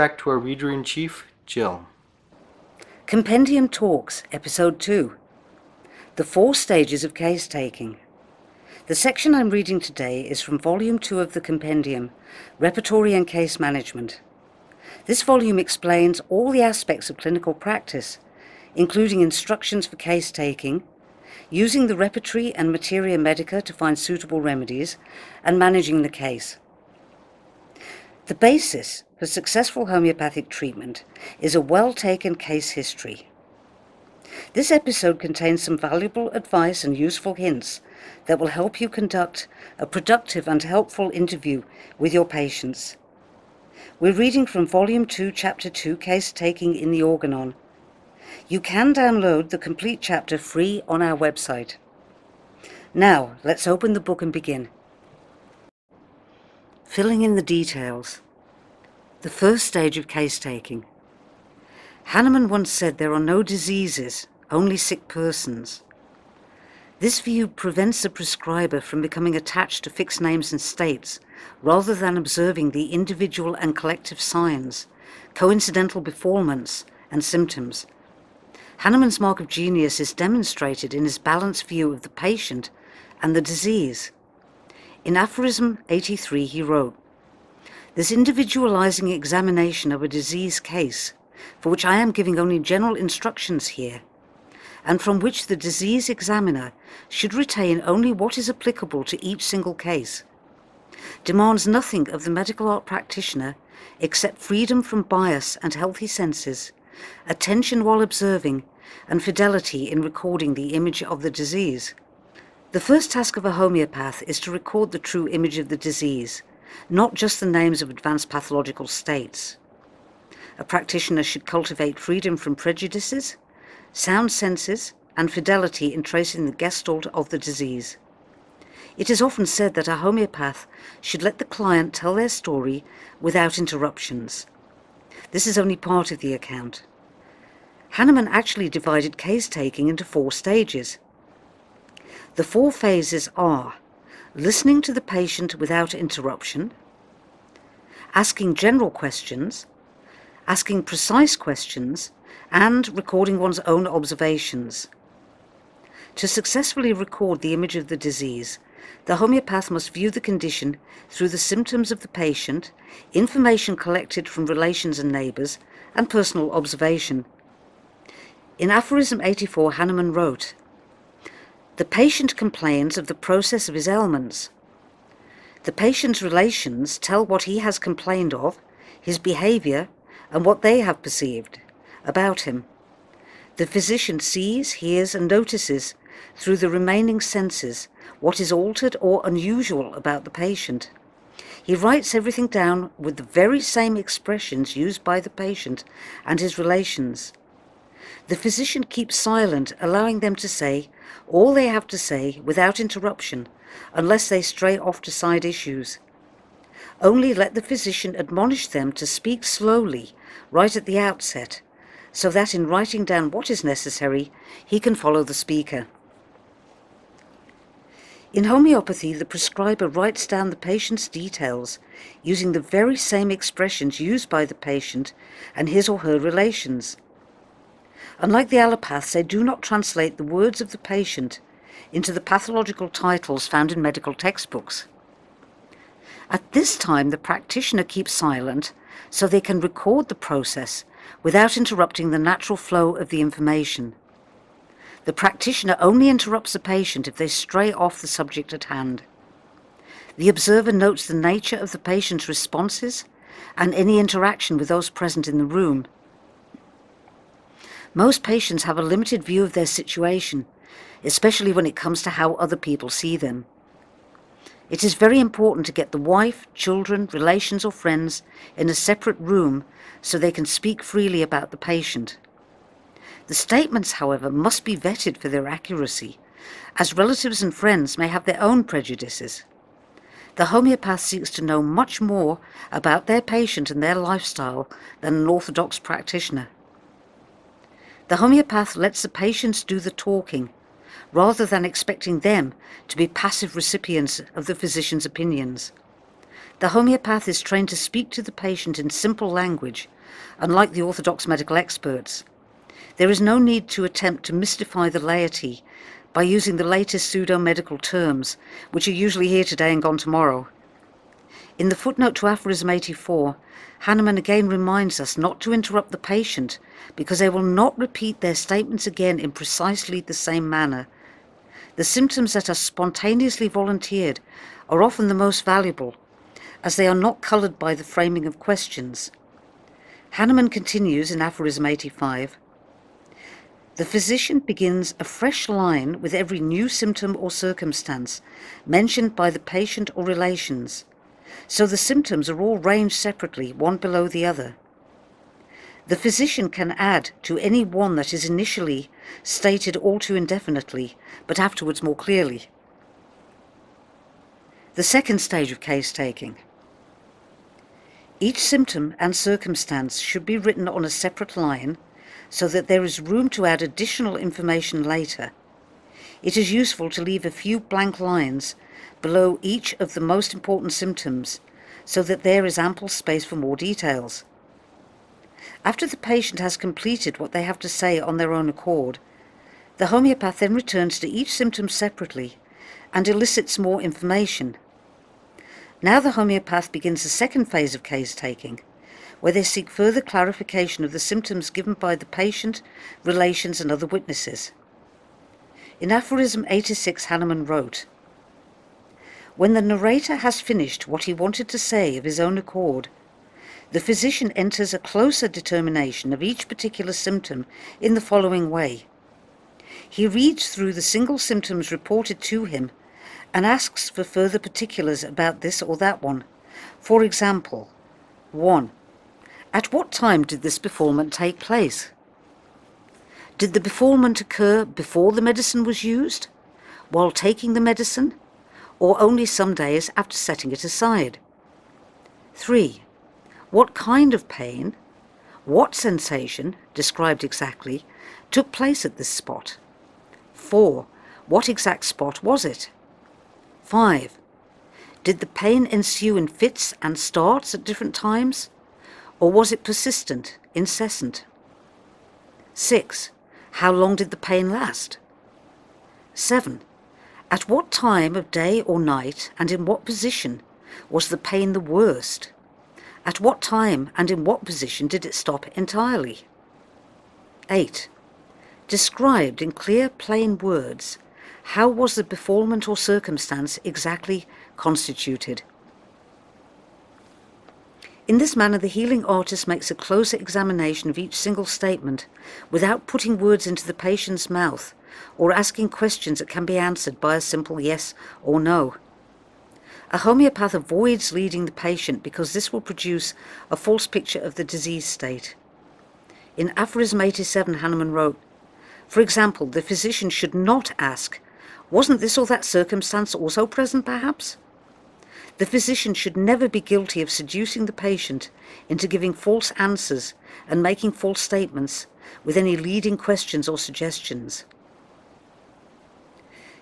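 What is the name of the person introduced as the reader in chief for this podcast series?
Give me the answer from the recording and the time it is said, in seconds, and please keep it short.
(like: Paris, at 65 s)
Jill, at 1 s.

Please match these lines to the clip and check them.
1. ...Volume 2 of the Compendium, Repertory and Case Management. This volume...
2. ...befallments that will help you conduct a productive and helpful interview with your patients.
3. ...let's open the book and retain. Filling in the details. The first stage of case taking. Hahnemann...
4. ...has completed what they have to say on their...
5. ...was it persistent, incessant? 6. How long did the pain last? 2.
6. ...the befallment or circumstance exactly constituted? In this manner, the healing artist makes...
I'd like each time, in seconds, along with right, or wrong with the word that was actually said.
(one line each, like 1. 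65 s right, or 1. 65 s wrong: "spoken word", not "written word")
1. 10 s right
2. 37 s wrong: "hints", not "befallments"
3. 53 s wrong: "begin", not "retain"
4. 376 s right
5. 449 s wrong: "7", not "2"
6. 471 s right.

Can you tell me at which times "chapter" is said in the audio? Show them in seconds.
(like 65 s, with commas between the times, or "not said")
45 s, 49 s.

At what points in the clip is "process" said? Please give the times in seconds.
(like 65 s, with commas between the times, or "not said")
173 s, 240 s.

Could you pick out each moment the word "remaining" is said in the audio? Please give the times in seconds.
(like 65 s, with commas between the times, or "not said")
186 s.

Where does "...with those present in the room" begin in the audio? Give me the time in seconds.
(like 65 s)
254 s.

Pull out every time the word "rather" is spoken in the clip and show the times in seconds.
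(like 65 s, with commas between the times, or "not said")
71 s, 291 s.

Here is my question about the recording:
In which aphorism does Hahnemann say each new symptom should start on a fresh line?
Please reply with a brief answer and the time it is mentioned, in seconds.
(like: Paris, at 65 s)
85, at 331 s.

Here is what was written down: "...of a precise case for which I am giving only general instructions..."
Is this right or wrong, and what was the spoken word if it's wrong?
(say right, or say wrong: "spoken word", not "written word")
wrong: "disease", not "precise".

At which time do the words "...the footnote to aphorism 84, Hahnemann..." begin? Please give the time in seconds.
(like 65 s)
311 s.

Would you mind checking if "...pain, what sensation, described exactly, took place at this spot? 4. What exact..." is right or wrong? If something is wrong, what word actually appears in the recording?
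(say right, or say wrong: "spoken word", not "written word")
right.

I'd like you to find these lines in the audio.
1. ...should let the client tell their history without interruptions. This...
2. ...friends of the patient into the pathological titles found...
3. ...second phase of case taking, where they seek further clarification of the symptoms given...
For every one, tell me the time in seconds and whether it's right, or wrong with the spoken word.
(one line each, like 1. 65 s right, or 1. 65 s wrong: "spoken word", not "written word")
1. 130 s wrong: "story", not "history"
2. 230 s wrong: "words", not "friends"
3. 387 s right.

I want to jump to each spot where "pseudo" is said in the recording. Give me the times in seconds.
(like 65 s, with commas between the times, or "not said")
307 s.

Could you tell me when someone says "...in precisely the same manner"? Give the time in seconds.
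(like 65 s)
319 s.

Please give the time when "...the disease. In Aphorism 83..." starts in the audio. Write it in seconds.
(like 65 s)
83 s.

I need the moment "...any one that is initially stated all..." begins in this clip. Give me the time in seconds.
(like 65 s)
347 s.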